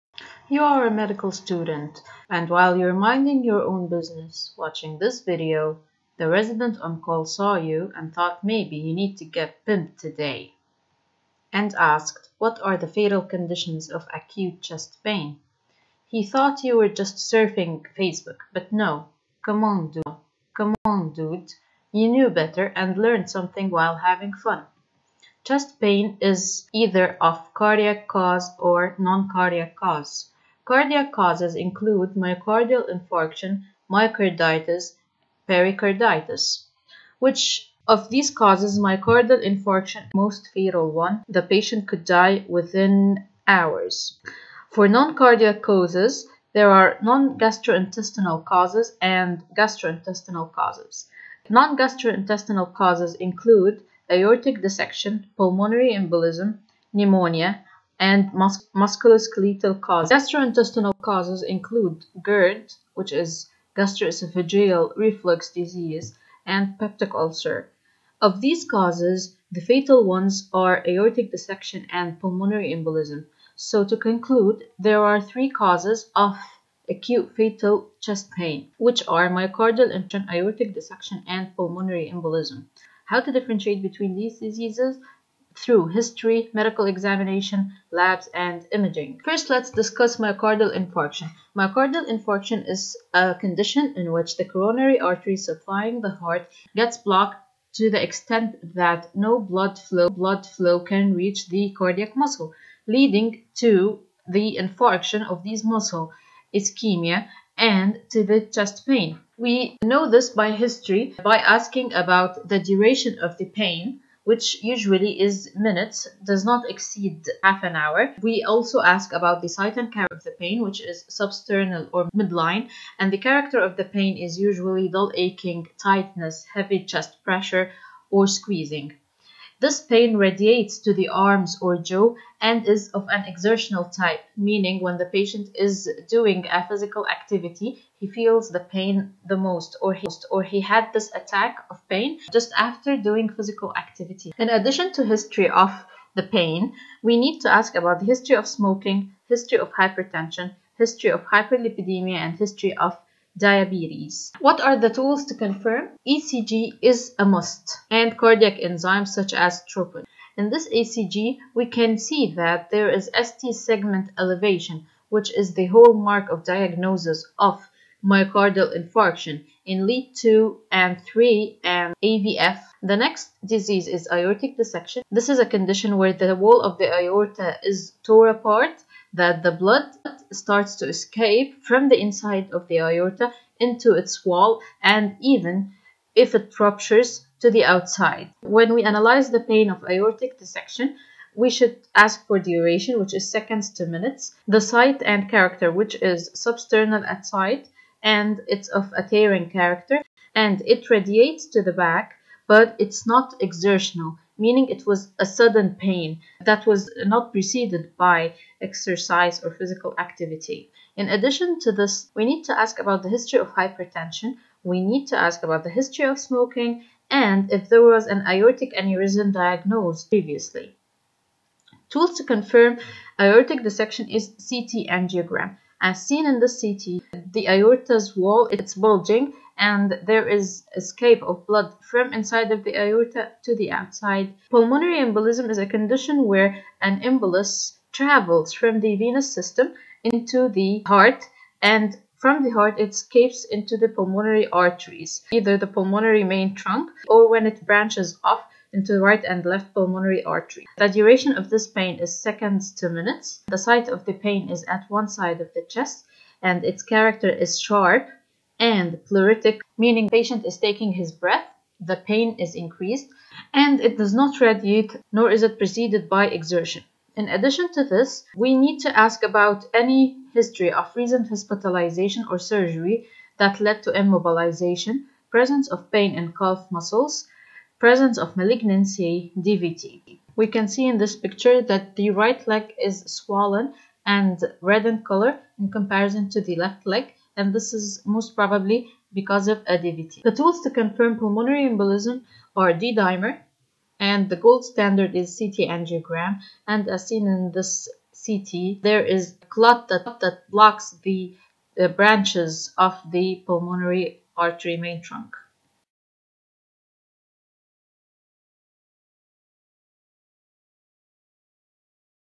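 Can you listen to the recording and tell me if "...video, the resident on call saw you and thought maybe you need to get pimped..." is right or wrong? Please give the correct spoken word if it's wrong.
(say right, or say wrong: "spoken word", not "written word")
right.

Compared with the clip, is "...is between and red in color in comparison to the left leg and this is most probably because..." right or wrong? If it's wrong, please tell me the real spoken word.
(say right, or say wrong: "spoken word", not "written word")
wrong: "swollen", not "between".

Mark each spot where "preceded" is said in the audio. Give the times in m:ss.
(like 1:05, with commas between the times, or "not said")
3:27, 4:25.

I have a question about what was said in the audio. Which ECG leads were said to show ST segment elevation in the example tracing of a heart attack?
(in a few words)
2, 3 and aVF.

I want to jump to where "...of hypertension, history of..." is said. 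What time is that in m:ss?
2:29.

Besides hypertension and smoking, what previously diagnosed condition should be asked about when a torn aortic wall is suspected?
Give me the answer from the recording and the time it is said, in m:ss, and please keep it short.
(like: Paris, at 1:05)
aortic aneurysm, at 3:38.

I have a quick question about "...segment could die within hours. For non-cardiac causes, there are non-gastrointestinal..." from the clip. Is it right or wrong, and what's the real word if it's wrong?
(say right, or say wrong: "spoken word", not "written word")
wrong: "patient", not "segment".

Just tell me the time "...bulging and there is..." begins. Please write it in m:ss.
3:48.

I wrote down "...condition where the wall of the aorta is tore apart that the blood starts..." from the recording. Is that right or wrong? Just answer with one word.
right.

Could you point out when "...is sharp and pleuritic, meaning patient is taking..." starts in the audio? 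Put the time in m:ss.
4:17.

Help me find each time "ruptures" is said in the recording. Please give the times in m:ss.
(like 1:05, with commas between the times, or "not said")
3:06.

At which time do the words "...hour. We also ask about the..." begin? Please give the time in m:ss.
1:57.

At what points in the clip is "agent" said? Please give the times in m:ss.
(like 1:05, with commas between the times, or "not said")
not said.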